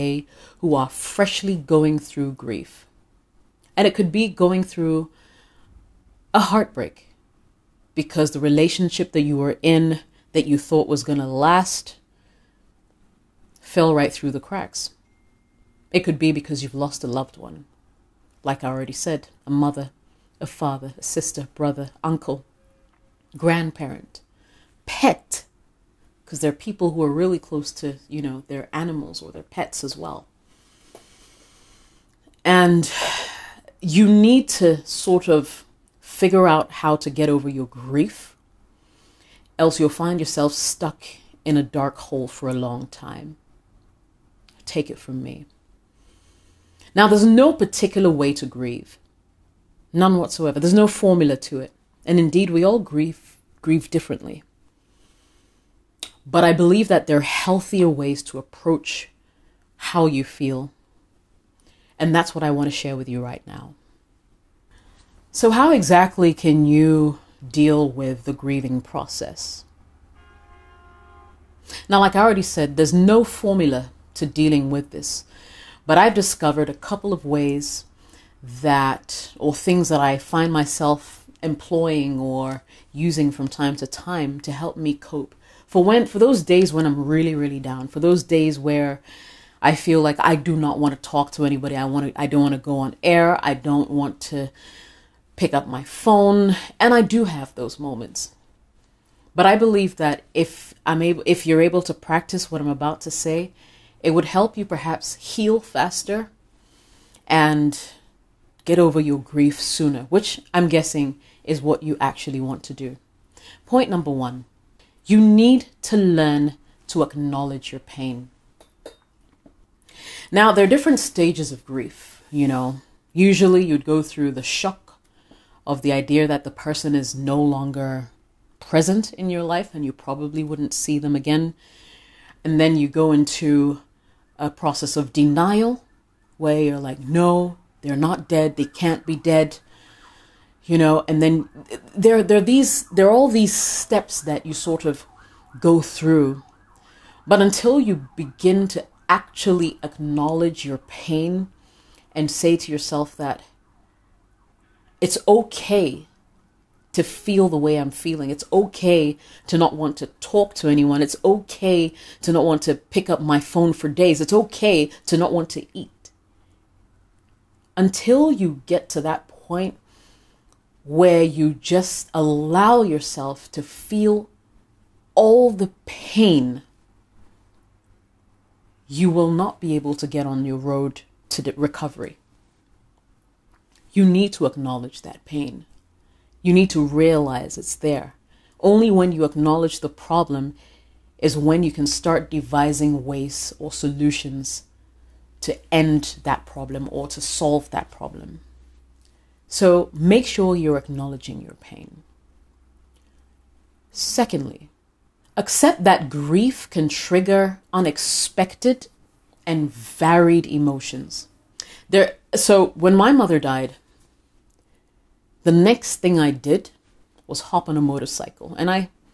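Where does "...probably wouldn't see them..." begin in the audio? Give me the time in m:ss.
2:09.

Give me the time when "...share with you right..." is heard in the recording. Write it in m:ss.
1:02.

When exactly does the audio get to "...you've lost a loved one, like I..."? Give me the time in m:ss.
0:16.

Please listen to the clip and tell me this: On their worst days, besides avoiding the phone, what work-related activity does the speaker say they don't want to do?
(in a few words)
go on air.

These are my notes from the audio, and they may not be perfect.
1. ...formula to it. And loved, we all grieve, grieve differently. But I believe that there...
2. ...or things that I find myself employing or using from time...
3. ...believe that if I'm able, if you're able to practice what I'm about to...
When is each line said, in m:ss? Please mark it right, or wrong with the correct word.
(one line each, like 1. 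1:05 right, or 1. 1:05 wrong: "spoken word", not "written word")
1. 0:50 wrong: "indeed", not "loved"
2. 1:19 right
3. 1:39 right.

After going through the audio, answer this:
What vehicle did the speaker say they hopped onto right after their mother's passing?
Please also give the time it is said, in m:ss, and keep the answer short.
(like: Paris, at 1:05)
motorcycle, at 3:37.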